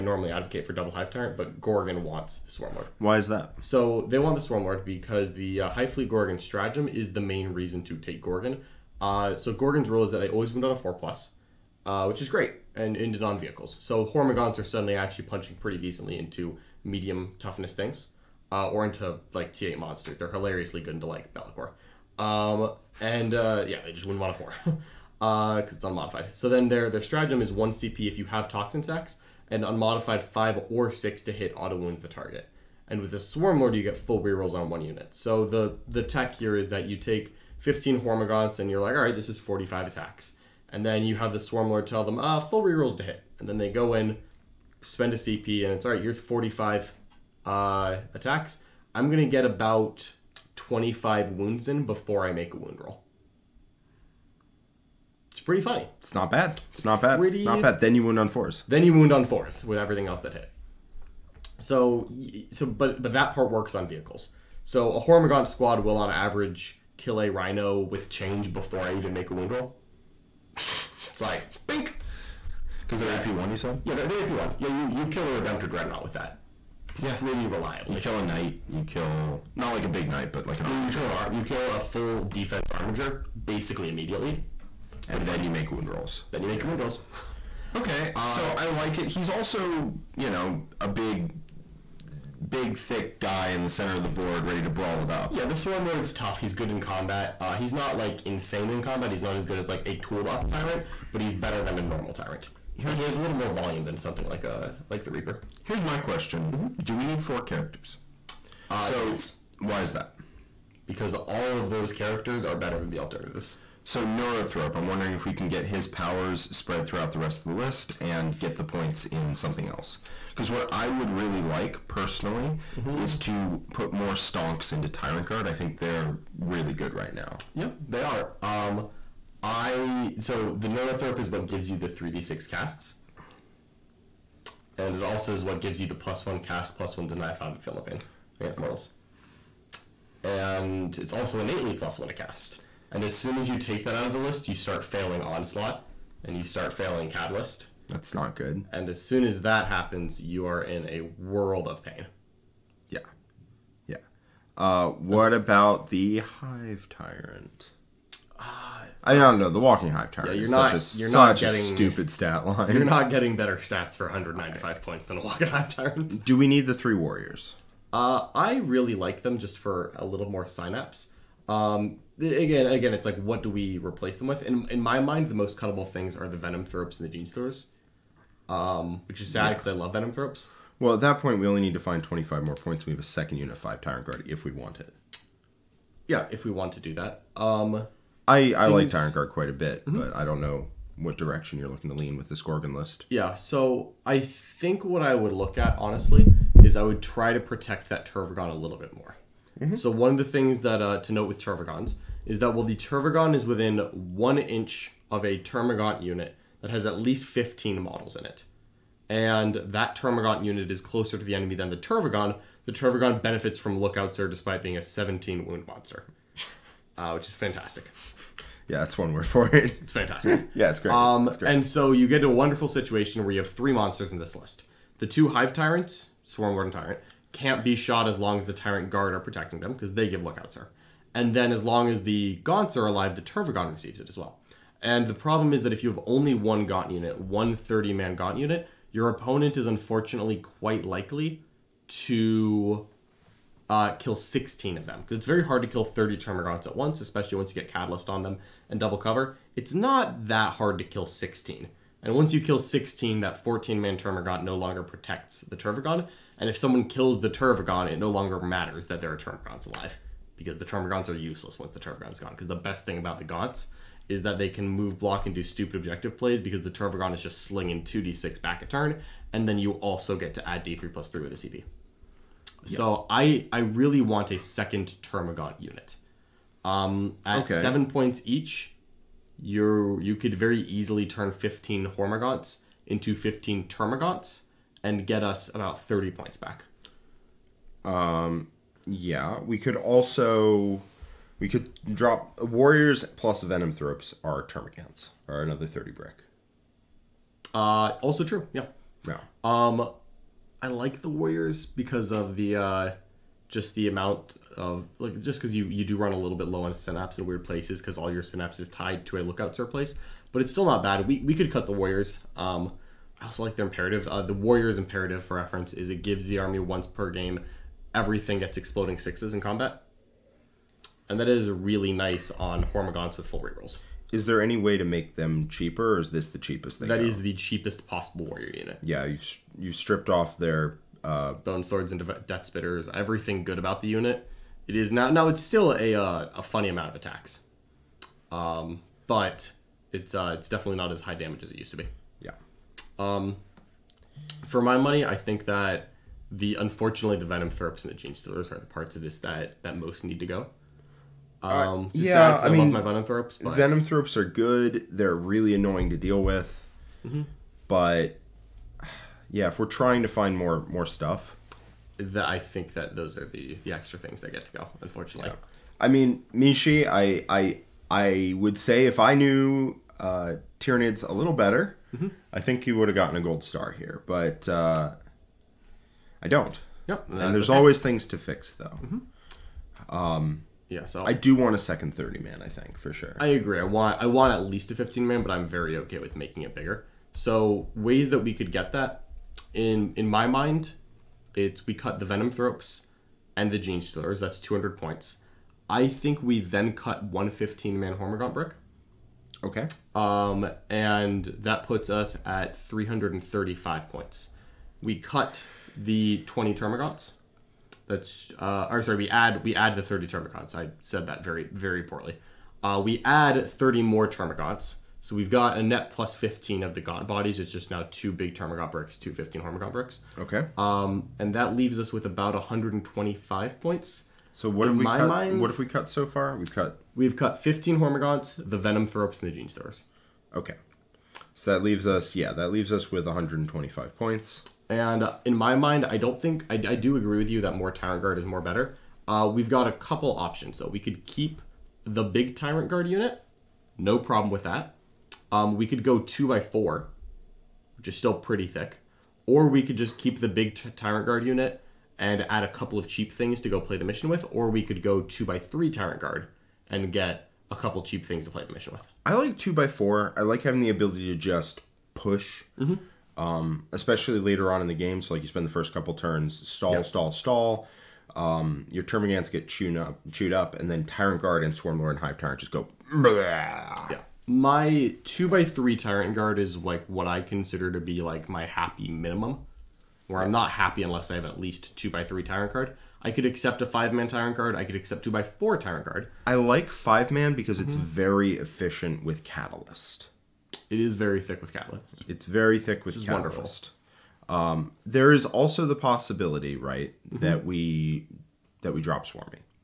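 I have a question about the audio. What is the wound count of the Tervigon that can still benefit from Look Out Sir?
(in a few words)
17.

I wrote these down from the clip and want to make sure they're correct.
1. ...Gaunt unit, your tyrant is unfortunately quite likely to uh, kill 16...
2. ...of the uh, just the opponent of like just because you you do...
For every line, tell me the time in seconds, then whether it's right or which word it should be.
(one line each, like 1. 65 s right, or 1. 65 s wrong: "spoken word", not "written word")
1. 238 s wrong: "opponent", not "tyrant"
2. 302 s wrong: "amount", not "opponent".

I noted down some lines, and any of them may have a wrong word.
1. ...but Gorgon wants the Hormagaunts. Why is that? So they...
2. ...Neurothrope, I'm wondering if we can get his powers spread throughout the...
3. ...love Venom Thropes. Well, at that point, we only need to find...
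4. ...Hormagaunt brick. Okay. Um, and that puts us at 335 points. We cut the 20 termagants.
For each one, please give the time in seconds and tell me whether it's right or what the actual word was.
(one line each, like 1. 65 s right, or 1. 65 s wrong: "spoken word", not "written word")
1. 1 s wrong: "Swarmlord", not "Hormagaunts"
2. 114 s right
3. 179 s right
4. 397 s right.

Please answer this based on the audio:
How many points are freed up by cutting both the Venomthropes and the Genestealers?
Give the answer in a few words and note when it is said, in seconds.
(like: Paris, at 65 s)
200 points, at 394 s.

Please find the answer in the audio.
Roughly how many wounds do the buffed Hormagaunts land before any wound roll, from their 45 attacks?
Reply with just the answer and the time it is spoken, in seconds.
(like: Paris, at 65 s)
About 25, at 49 s.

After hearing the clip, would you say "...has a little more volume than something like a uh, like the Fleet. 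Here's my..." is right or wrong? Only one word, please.
wrong.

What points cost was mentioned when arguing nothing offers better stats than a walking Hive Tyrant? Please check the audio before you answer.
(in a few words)
195.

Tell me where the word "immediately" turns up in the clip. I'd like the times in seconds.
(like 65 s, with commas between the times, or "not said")
83 s.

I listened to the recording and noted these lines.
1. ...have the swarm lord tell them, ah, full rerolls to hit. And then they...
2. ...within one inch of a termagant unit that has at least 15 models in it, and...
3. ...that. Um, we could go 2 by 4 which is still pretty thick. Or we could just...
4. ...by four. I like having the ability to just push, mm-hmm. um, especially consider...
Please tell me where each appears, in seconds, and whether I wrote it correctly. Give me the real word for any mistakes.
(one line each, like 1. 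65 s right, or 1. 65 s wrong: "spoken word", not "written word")
1. 41 s right
2. 203 s right
3. 444 s right
4. 459 s wrong: "later", not "consider".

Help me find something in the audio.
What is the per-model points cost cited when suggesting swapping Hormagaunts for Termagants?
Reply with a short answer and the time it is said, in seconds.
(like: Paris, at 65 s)
7 points, at 277 s.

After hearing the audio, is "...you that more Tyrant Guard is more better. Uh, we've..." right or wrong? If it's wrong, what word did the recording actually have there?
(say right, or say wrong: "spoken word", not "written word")
right.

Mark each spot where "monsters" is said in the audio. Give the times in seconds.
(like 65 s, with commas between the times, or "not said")
19 s, 215 s, 223 s.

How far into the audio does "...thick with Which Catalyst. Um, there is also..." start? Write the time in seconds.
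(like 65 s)
492 s.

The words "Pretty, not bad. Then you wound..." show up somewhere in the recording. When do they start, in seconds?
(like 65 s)
57 s.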